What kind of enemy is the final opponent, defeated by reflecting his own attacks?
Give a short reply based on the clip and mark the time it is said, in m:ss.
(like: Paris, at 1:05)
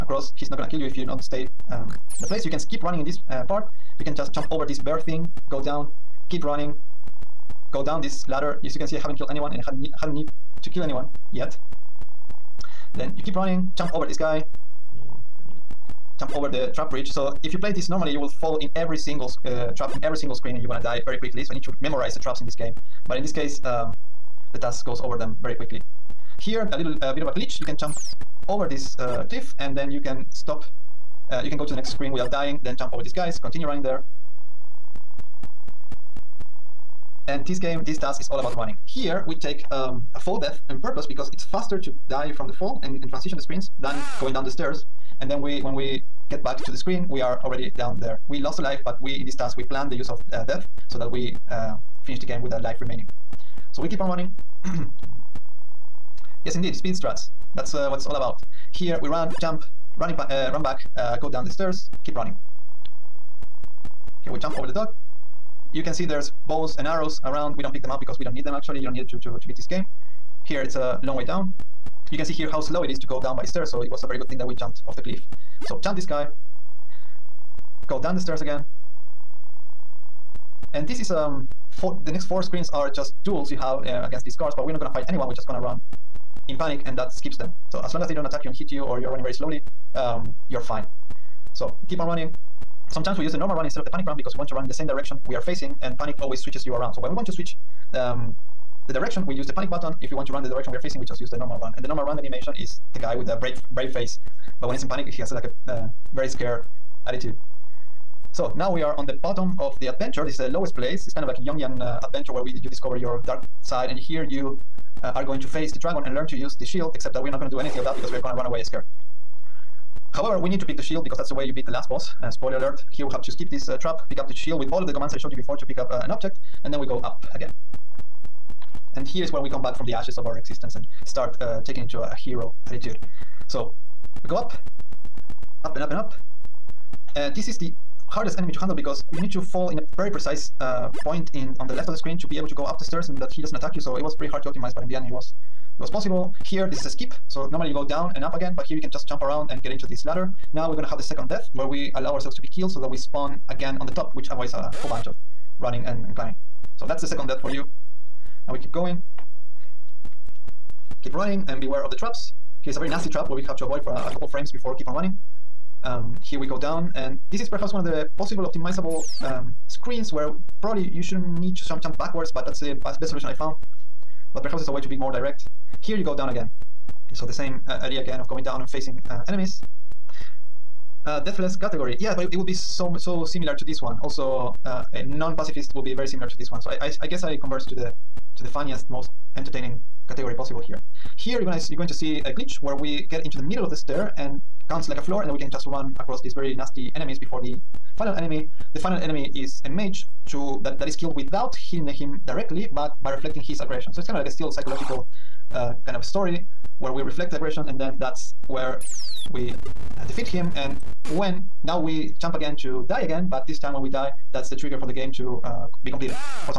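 a mage, at 3:19.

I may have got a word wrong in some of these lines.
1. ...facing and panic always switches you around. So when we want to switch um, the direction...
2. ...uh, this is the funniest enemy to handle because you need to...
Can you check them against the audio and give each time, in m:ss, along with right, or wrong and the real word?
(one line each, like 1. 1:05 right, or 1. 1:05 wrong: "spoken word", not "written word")
1. 1:35 right
2. 2:17 wrong: "hardest", not "funniest".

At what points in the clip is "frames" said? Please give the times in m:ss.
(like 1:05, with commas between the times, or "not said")
2:44.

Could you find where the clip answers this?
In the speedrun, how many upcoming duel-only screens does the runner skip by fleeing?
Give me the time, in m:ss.
1:22.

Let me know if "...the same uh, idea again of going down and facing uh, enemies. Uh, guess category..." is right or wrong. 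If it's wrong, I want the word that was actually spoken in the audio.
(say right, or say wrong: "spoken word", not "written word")
wrong: "deathless", not "guess".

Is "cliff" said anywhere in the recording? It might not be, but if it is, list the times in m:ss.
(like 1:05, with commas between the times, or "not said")
0:29, 1:15.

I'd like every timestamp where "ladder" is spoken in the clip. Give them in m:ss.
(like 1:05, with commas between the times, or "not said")
0:08, 2:30.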